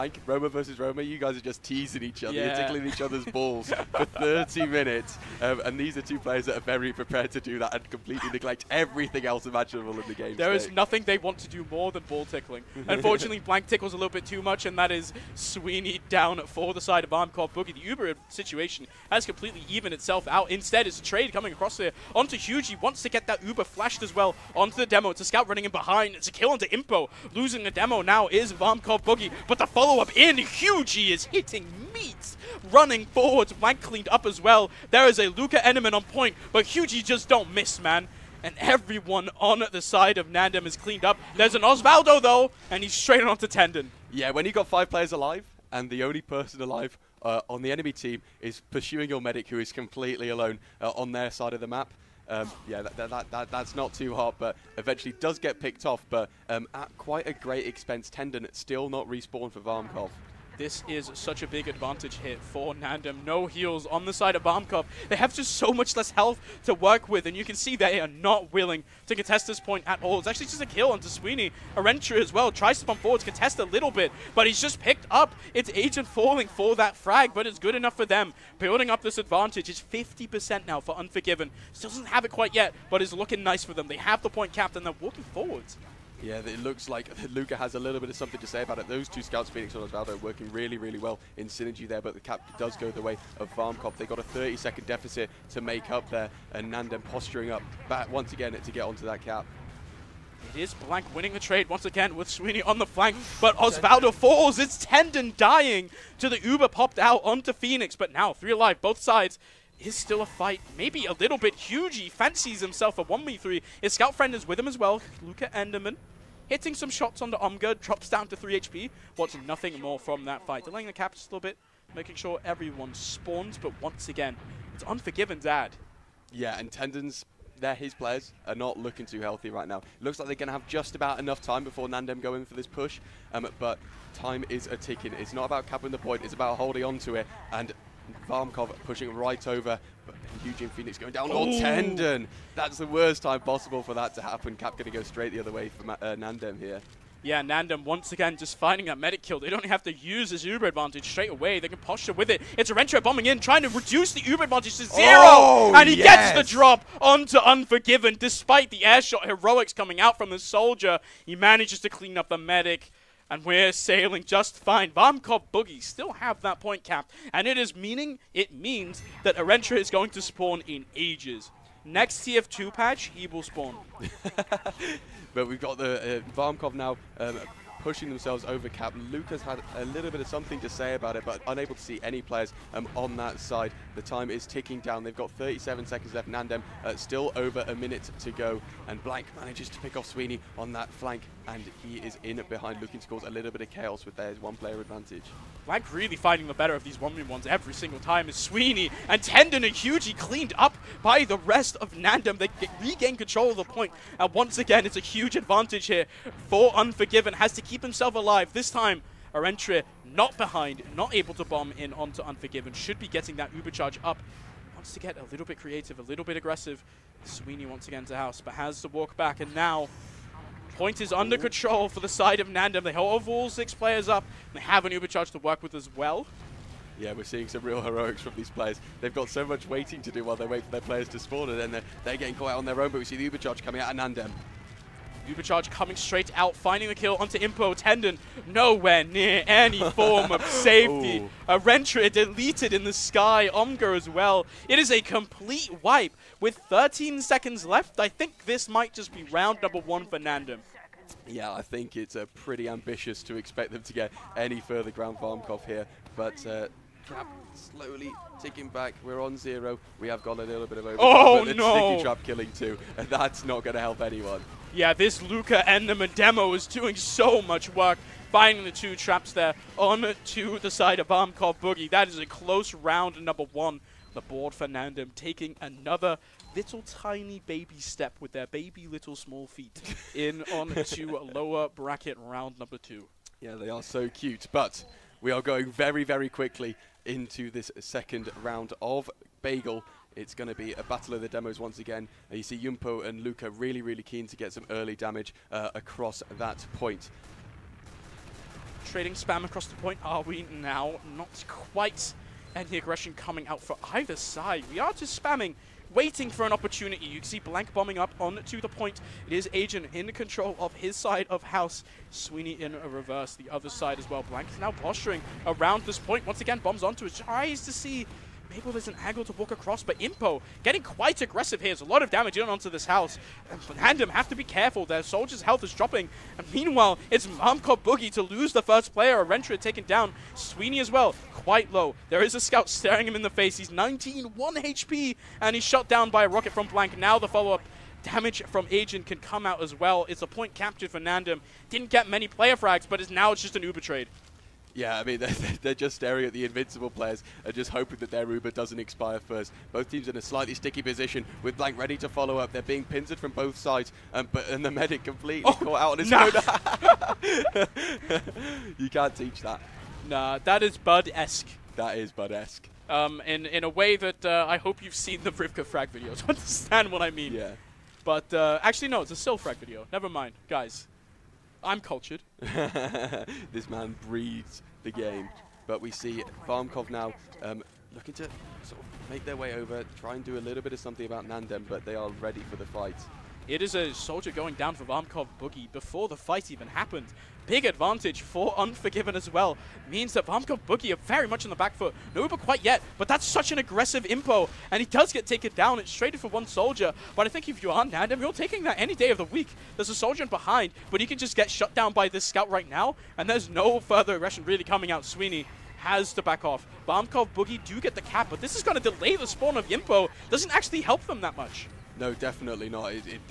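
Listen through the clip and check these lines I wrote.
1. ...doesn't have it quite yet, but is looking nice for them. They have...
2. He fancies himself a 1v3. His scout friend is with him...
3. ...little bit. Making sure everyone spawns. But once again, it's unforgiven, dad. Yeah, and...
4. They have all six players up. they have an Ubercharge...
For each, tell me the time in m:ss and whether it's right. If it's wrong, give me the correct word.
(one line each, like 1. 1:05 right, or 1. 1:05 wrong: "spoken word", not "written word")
1. 1:21 right
2. 1:51 right
3. 2:01 right
4. 3:42 right.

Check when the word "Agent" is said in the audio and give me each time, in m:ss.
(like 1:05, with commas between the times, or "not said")
1:15, 5:09, 5:38.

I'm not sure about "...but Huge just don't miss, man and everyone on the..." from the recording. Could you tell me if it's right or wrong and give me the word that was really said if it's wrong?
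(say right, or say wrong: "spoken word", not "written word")
right.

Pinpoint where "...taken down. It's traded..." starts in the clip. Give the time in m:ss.
6:35.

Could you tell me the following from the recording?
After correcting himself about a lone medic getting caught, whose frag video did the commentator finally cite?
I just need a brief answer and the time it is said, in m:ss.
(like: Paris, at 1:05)
Sil, at 6:09.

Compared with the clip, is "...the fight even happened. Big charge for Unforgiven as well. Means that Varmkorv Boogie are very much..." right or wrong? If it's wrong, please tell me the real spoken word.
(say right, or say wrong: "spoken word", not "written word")
wrong: "advantage", not "charge".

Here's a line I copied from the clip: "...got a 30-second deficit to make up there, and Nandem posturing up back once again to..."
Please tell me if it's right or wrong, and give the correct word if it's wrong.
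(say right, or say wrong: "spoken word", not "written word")
right.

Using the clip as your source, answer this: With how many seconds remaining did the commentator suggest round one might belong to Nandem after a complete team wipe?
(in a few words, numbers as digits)
13.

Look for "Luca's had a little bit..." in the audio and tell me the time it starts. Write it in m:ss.
2:59.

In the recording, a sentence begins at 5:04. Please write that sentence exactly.
We are just spamming waiting for an opportunity.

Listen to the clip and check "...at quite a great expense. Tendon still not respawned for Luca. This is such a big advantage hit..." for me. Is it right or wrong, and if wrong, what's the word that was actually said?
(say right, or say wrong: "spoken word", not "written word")
wrong: "Varmkorv", not "Luca".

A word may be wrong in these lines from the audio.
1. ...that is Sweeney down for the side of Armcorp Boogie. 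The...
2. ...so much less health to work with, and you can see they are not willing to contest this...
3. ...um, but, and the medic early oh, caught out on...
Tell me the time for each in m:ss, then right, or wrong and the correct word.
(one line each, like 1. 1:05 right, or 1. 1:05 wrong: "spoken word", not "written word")
1. 0:14 right
2. 1:05 right
3. 5:54 wrong: "completely", not "early".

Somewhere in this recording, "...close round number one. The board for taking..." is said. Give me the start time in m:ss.
4:32.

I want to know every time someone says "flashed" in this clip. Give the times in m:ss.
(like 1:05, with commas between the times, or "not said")
0:23.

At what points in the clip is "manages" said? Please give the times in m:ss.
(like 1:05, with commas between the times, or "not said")
2:41, 3:09.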